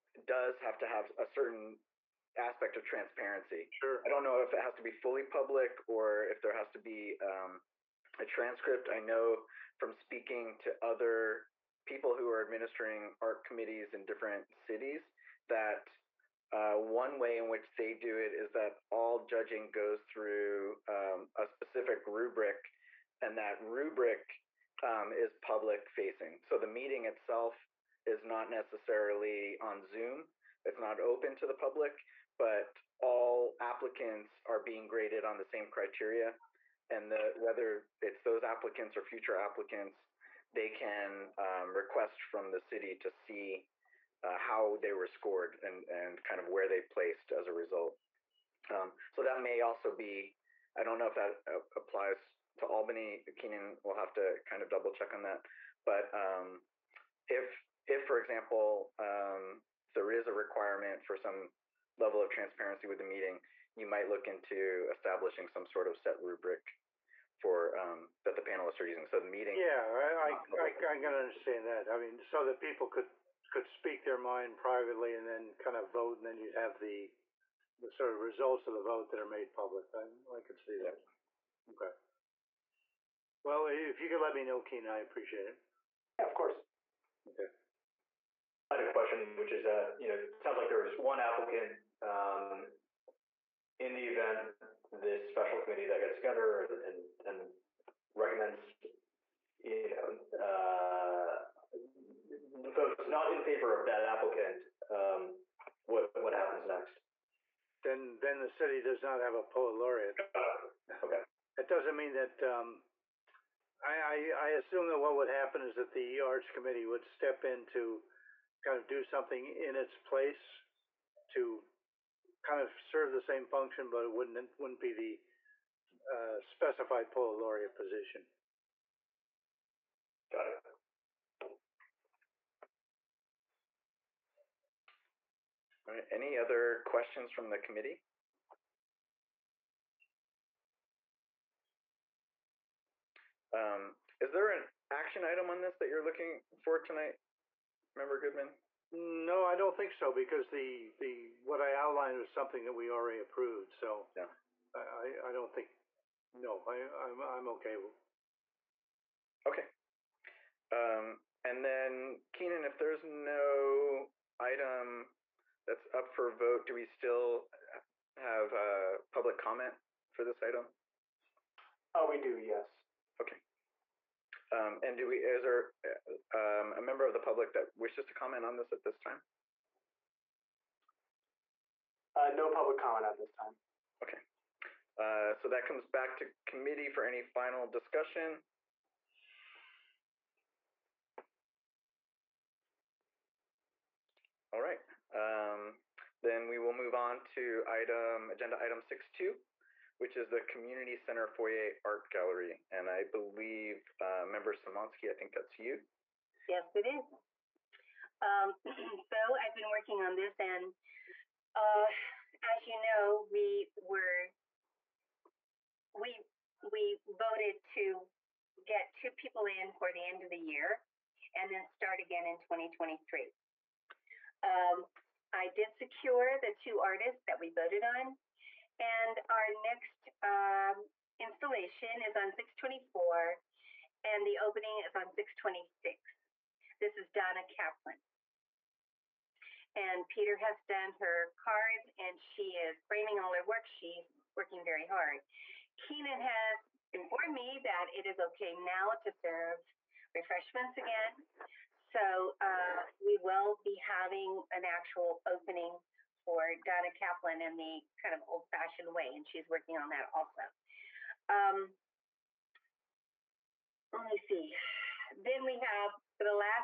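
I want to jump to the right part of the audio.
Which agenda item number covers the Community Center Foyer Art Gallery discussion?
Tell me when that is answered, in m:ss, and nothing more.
3:18.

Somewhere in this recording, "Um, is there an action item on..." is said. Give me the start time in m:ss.
2:23.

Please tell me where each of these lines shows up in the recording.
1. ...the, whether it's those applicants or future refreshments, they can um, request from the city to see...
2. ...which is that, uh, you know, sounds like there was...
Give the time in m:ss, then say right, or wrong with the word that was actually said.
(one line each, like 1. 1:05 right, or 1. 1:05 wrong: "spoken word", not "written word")
1. 0:37 wrong: "applicants", not "refreshments"
2. 1:29 right.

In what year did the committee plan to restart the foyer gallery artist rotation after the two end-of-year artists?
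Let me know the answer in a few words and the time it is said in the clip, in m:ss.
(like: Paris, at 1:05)
2023, at 3:42.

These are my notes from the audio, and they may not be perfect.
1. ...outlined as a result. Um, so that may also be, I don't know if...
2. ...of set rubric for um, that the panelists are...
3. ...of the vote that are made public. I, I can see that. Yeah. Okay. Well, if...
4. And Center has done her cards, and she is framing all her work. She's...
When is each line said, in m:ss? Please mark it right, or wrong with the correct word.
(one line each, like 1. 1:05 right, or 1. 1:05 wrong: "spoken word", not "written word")
1. 0:46 wrong: "placed", not "outlined"
2. 1:05 right
3. 1:18 right
4. 3:59 wrong: "Peter", not "Center".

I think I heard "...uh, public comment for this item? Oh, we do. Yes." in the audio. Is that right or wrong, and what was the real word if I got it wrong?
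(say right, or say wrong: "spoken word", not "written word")
right.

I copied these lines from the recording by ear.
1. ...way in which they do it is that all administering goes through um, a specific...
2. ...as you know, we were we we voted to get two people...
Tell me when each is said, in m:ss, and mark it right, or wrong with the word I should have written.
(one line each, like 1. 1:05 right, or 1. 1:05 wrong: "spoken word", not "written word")
1. 0:17 wrong: "judging", not "administering"
2. 3:32 right.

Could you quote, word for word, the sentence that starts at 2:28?
No, I don't think so because the the what I outlined was something that we already approved.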